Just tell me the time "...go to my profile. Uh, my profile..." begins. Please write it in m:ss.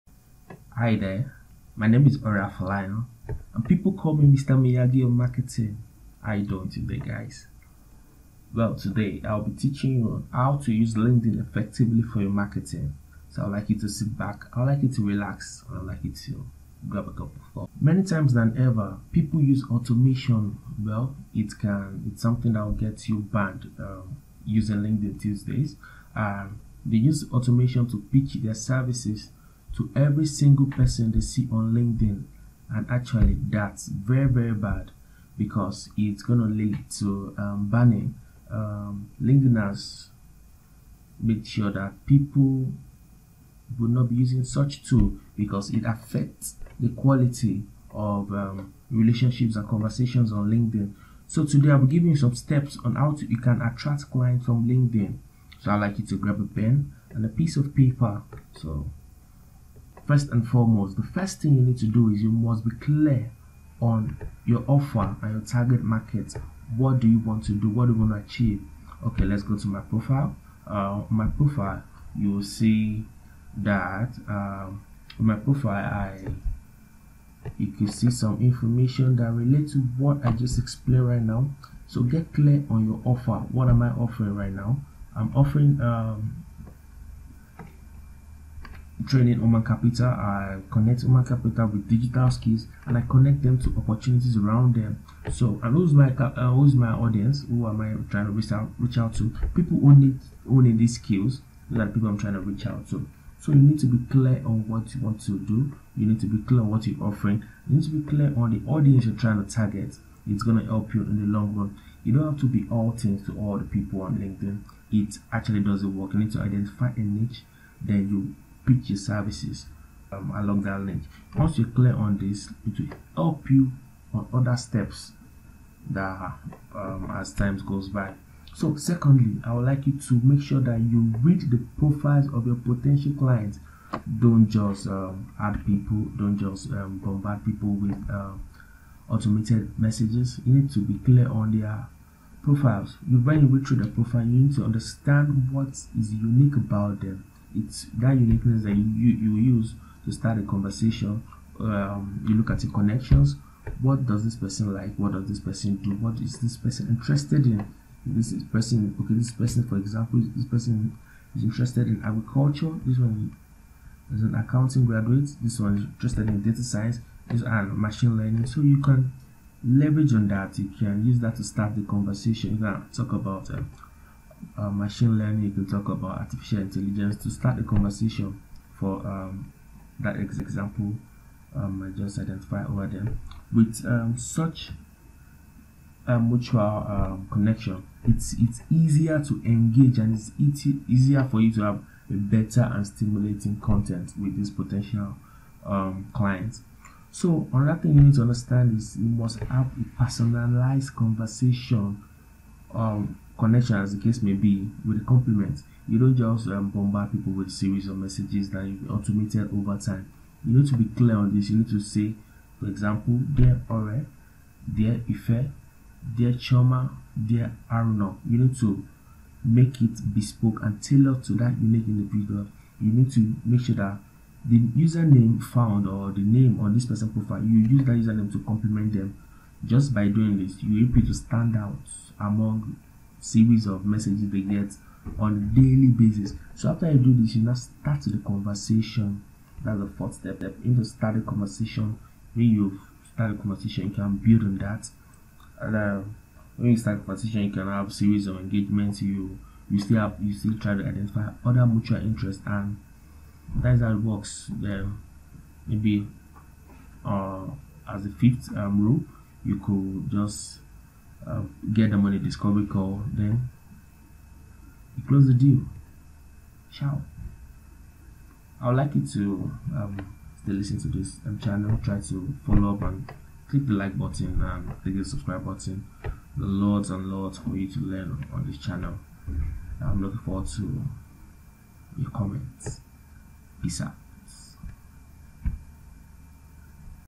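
1:09.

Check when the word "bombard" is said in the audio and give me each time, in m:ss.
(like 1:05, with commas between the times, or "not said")
2:17, 3:26.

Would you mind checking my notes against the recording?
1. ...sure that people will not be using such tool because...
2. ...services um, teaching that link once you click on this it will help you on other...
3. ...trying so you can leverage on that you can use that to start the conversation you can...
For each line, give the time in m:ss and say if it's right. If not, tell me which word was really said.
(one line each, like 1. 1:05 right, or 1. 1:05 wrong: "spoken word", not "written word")
1. 0:41 right
2. 1:58 wrong: "along", not "teaching"
3. 2:48 wrong: "learning", not "trying".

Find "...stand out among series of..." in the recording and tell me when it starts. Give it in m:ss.
3:51.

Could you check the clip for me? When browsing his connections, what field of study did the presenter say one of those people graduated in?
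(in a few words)
Accounting.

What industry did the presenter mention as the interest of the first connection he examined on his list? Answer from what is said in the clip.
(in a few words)
Agriculture.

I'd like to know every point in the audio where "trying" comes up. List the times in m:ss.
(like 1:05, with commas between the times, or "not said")
1:38, 1:42, 1:49.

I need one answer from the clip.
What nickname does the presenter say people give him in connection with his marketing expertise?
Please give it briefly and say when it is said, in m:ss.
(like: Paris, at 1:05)
Mr. Miyagi of Marketing, at 0:04.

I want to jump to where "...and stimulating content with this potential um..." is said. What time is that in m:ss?
3:12.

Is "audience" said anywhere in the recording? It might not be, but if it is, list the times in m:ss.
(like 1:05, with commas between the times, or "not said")
1:36, 1:48.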